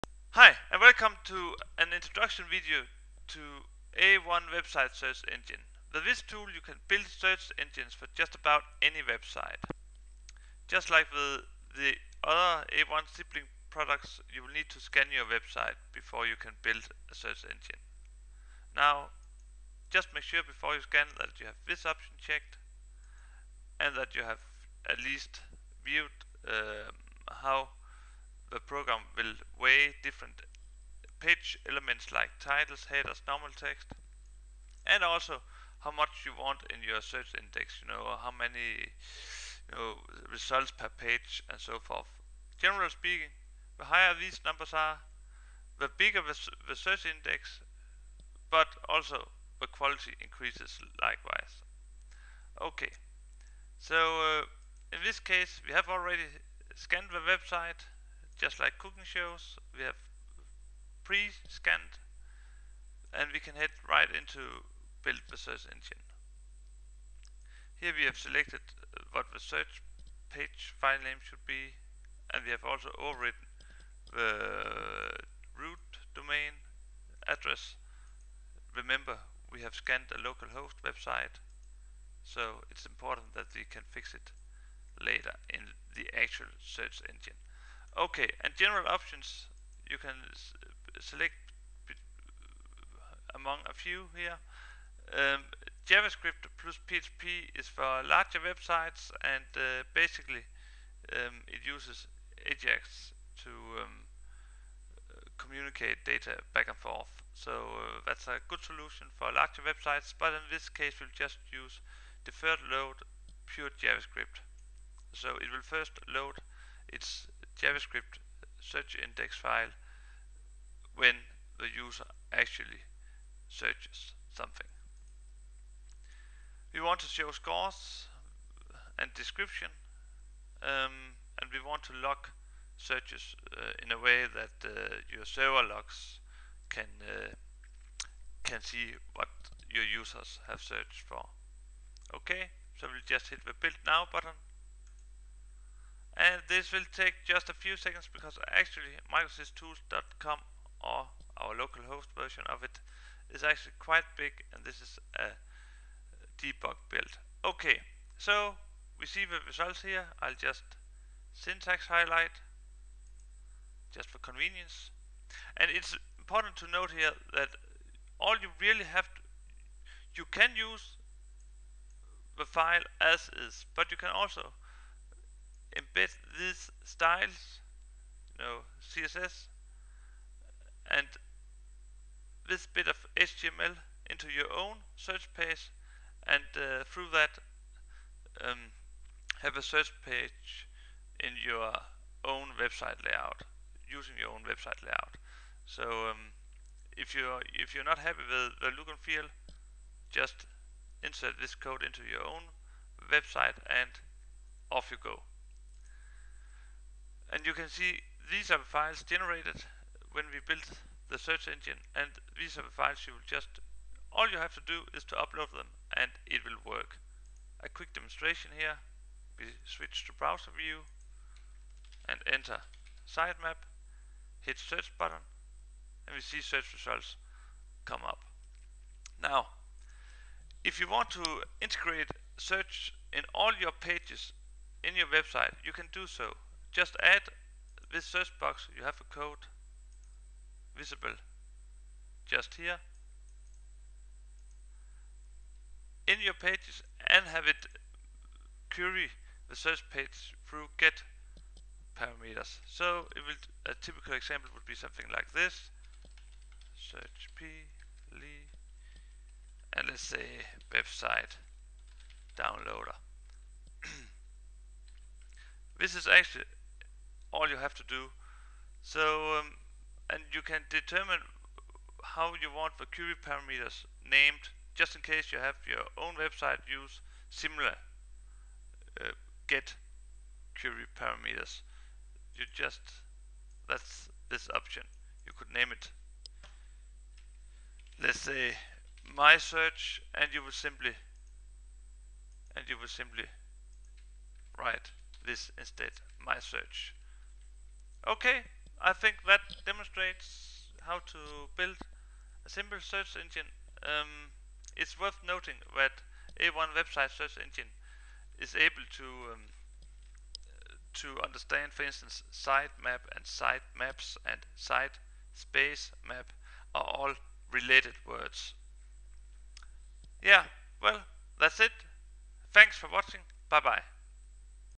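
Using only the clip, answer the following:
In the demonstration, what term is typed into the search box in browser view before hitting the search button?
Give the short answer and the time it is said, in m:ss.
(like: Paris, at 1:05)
sitemap, at 3:43.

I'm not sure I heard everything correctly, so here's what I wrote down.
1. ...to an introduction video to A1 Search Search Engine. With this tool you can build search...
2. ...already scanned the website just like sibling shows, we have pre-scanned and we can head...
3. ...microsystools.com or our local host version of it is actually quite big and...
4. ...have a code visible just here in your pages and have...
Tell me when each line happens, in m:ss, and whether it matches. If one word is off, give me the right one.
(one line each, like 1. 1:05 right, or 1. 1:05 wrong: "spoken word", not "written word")
1. 0:01 wrong: "Website", not "Search"
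2. 0:55 wrong: "cooking", not "sibling"
3. 2:29 right
4. 3:58 right.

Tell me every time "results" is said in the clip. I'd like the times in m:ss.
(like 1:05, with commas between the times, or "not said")
0:40, 2:39, 3:46.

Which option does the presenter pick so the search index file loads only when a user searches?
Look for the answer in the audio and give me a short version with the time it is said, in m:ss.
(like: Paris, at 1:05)
Deferred load pure JavaScript, at 1:52.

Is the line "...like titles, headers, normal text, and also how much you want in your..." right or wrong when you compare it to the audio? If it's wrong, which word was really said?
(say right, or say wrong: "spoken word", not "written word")
right.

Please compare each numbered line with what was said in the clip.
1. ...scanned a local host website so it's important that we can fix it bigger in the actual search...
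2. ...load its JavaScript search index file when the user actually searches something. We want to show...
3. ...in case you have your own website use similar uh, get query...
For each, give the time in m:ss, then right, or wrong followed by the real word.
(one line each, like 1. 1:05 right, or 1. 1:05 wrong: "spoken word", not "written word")
1. 1:19 wrong: "later", not "bigger"
2. 1:56 right
3. 4:34 right.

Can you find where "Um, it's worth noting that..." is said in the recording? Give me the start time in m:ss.
5:03.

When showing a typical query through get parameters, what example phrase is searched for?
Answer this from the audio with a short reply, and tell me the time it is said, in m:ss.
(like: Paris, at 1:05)
website downloader, at 4:20.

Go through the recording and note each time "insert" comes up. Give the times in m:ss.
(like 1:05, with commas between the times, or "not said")
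3:21.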